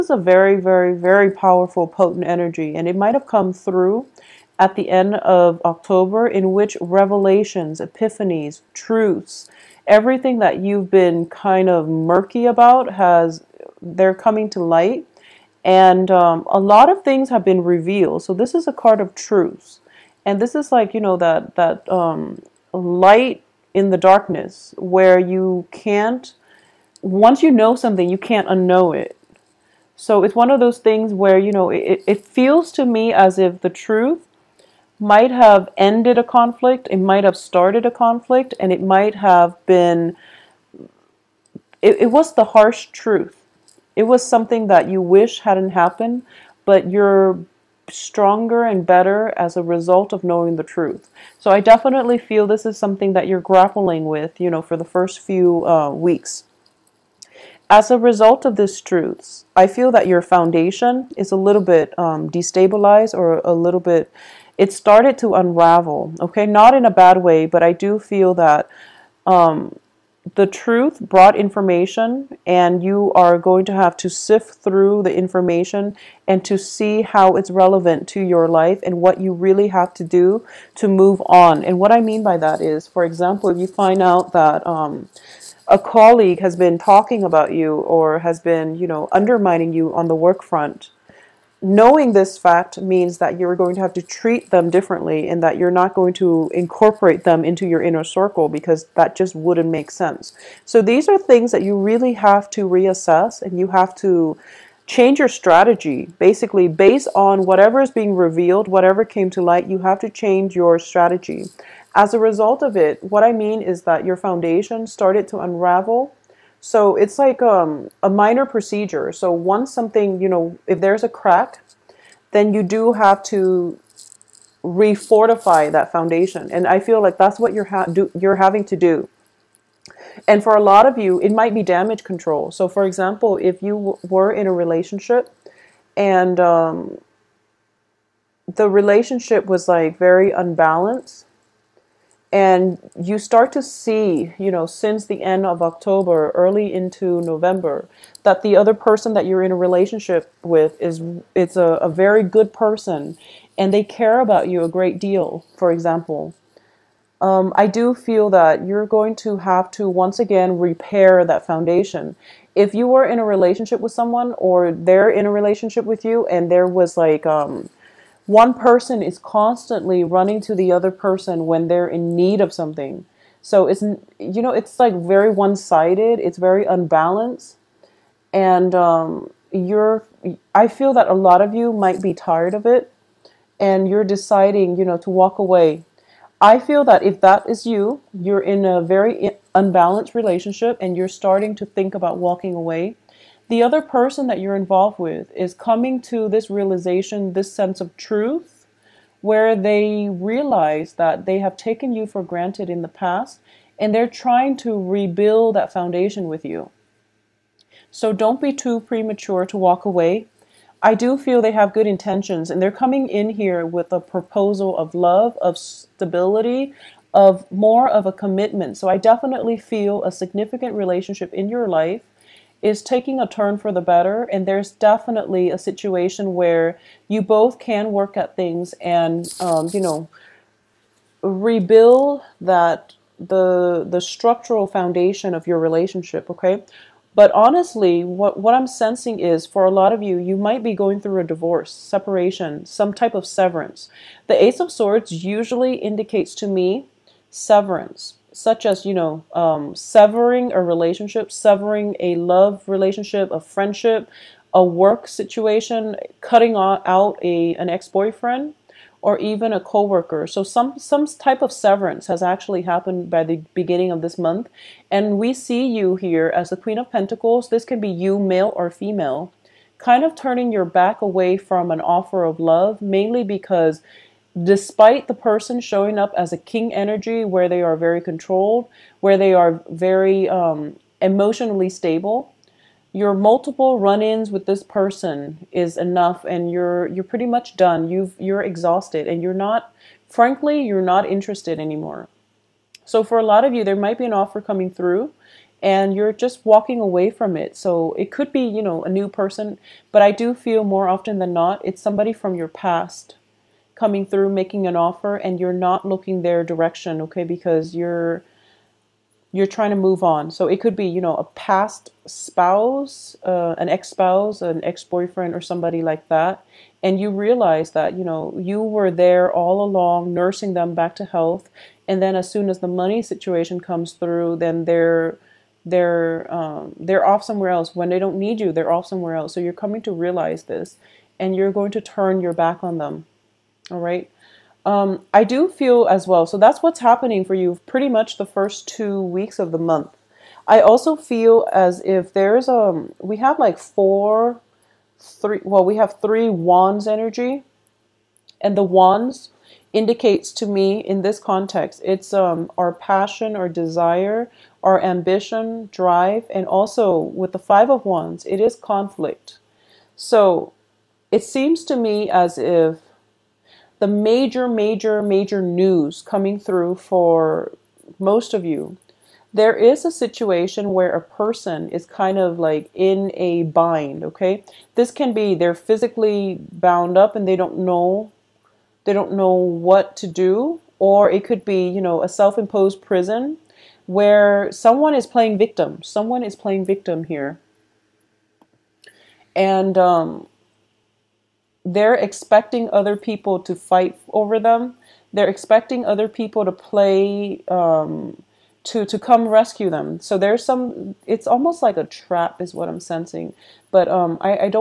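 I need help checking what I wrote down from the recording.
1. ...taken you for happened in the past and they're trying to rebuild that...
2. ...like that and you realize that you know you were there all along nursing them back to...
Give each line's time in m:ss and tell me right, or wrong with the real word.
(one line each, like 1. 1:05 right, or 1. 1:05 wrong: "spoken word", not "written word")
1. 3:21 wrong: "granted", not "happened"
2. 5:15 right.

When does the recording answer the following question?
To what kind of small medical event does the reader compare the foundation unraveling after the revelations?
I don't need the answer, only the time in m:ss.
1:58.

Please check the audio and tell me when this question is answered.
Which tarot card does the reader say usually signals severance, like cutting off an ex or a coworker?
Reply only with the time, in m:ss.
4:04.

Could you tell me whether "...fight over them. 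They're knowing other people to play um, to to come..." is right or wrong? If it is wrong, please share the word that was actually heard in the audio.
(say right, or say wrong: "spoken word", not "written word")
wrong: "expecting", not "knowing".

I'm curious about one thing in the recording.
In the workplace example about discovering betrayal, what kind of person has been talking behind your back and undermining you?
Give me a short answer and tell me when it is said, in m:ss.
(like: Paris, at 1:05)
A colleague, at 1:25.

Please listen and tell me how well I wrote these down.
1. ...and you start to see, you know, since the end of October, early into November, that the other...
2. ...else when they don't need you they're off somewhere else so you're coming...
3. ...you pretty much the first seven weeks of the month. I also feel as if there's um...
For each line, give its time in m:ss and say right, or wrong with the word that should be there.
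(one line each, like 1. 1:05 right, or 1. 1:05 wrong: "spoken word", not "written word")
1. 2:22 right
2. 5:27 right
3. 5:37 wrong: "two", not "seven".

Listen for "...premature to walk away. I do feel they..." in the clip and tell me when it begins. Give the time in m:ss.
3:28.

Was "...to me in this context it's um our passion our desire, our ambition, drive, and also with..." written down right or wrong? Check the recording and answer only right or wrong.
right.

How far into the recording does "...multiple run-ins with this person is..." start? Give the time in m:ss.
4:43.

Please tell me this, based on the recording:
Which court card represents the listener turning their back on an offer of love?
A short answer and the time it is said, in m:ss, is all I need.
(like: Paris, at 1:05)
Queen of Pentacles, at 4:26.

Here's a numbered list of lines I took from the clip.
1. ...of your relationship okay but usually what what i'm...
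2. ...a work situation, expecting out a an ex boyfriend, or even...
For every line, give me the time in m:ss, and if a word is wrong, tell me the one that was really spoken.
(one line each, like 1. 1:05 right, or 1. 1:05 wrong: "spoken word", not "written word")
1. 3:55 wrong: "honestly", not "usually"
2. 4:14 wrong: "cutting", not "expecting".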